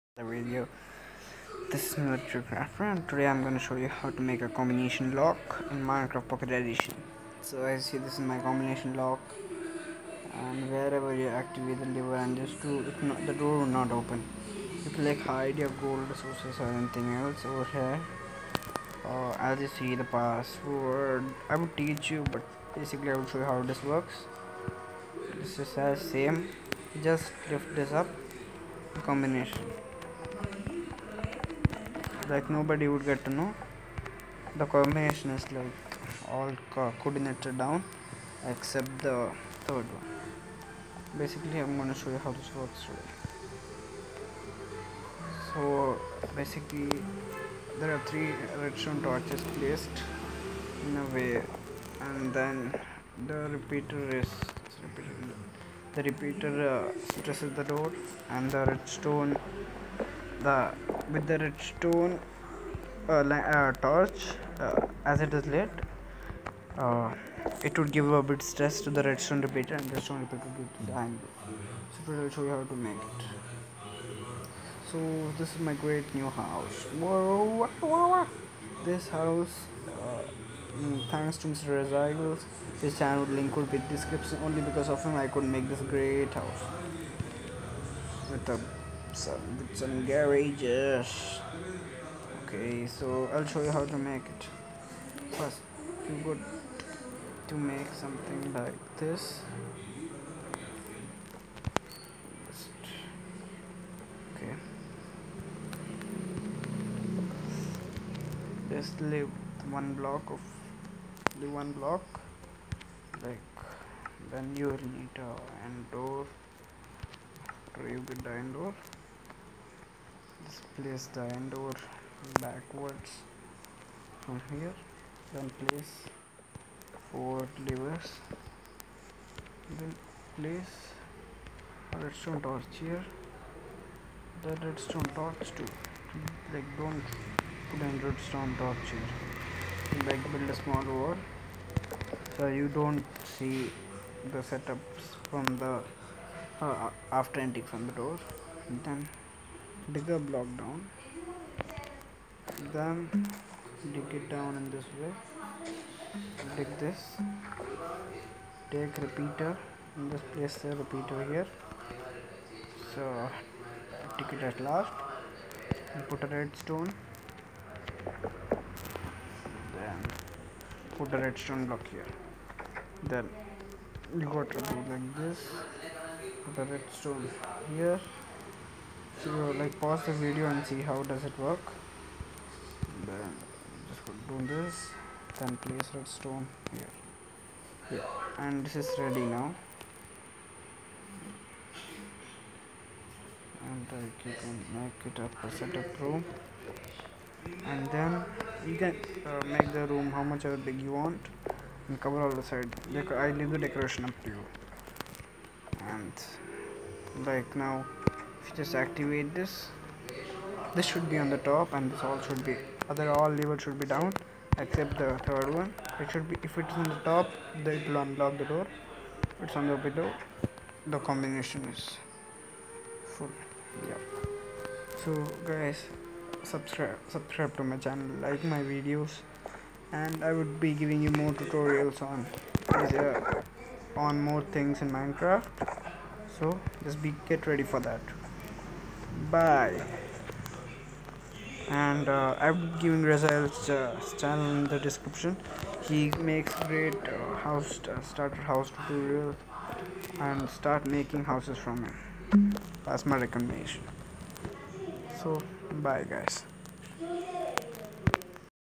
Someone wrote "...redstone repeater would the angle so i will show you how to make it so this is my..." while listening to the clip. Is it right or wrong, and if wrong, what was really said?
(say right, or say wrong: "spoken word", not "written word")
right.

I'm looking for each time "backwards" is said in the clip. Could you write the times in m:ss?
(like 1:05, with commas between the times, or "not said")
2:02.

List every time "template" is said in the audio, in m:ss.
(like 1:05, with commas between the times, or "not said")
not said.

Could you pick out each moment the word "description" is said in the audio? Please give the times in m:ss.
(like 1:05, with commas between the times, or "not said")
1:23, 4:04.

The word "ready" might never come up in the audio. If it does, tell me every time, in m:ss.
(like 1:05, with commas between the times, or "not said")
3:08, 3:57.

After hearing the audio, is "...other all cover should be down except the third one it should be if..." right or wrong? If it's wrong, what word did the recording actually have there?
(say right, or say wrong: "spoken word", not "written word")
wrong: "lever", not "cover".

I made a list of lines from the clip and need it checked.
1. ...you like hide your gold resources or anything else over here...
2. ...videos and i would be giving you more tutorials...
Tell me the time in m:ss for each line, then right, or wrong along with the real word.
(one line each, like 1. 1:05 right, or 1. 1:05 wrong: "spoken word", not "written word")
1. 0:14 right
2. 3:48 right.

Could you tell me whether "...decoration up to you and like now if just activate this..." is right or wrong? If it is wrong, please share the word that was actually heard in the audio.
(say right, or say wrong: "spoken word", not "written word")
right.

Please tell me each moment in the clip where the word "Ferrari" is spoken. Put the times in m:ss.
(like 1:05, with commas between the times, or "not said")
not said.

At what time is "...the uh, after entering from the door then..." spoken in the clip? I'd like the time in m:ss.
2:25.